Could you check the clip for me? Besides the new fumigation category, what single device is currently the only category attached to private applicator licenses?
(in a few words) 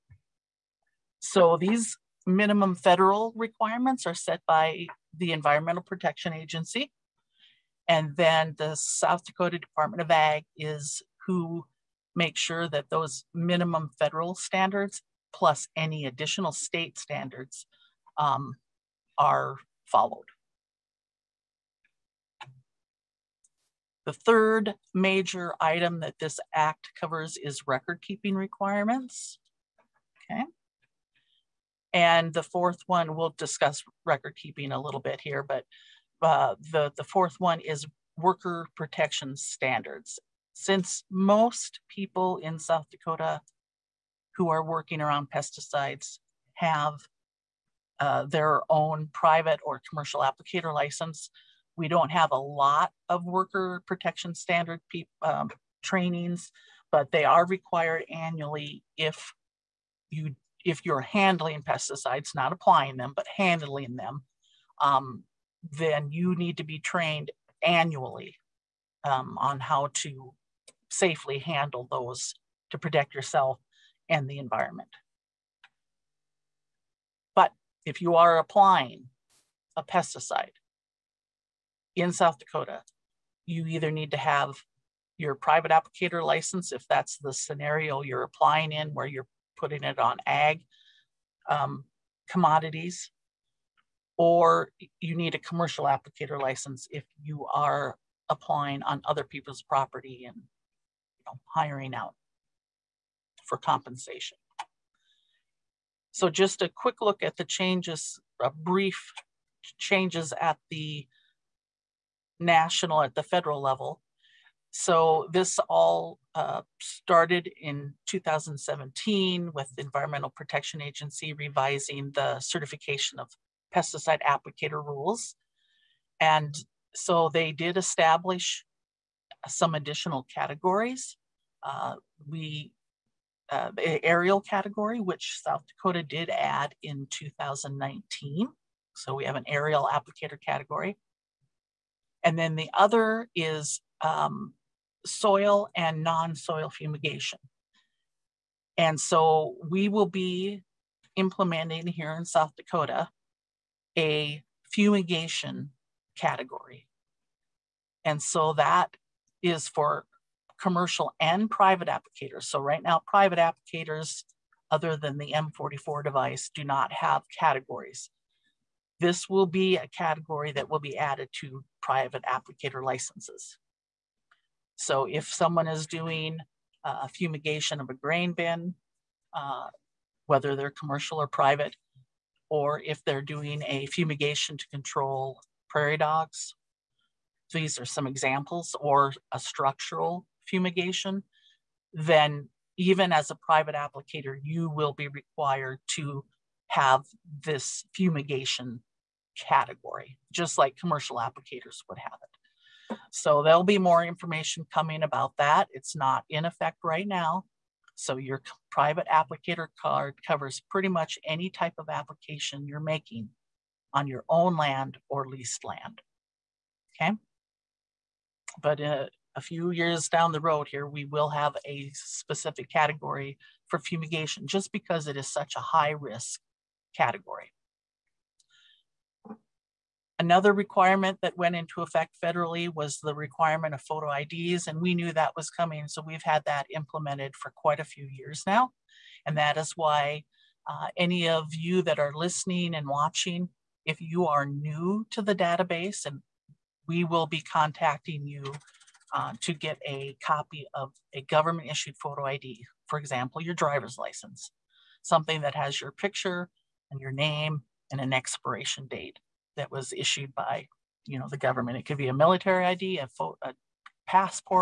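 M44 device.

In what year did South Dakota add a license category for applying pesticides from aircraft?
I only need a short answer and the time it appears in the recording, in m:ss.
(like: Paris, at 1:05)
2019, at 2:17.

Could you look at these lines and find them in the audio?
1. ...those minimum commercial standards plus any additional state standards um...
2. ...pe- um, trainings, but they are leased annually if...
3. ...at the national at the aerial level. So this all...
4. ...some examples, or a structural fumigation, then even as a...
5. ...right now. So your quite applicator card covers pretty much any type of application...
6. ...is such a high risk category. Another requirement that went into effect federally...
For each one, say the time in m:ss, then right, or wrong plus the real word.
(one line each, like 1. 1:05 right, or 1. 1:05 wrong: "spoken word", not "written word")
1. 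0:12 wrong: "federal", not "commercial"
2. 0:54 wrong: "required", not "leased"
3. 1:50 wrong: "federal", not "aerial"
4. 3:07 right
5. 3:26 wrong: "private", not "quite"
6. 3:45 right.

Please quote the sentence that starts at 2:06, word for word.
And so they did establish some additional categories.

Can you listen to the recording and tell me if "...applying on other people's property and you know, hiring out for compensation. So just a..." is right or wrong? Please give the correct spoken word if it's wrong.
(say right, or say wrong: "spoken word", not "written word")
right.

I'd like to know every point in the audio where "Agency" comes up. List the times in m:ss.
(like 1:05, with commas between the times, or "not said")
0:06, 2:00.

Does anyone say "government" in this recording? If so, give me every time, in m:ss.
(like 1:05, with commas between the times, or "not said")
4:11, 4:21.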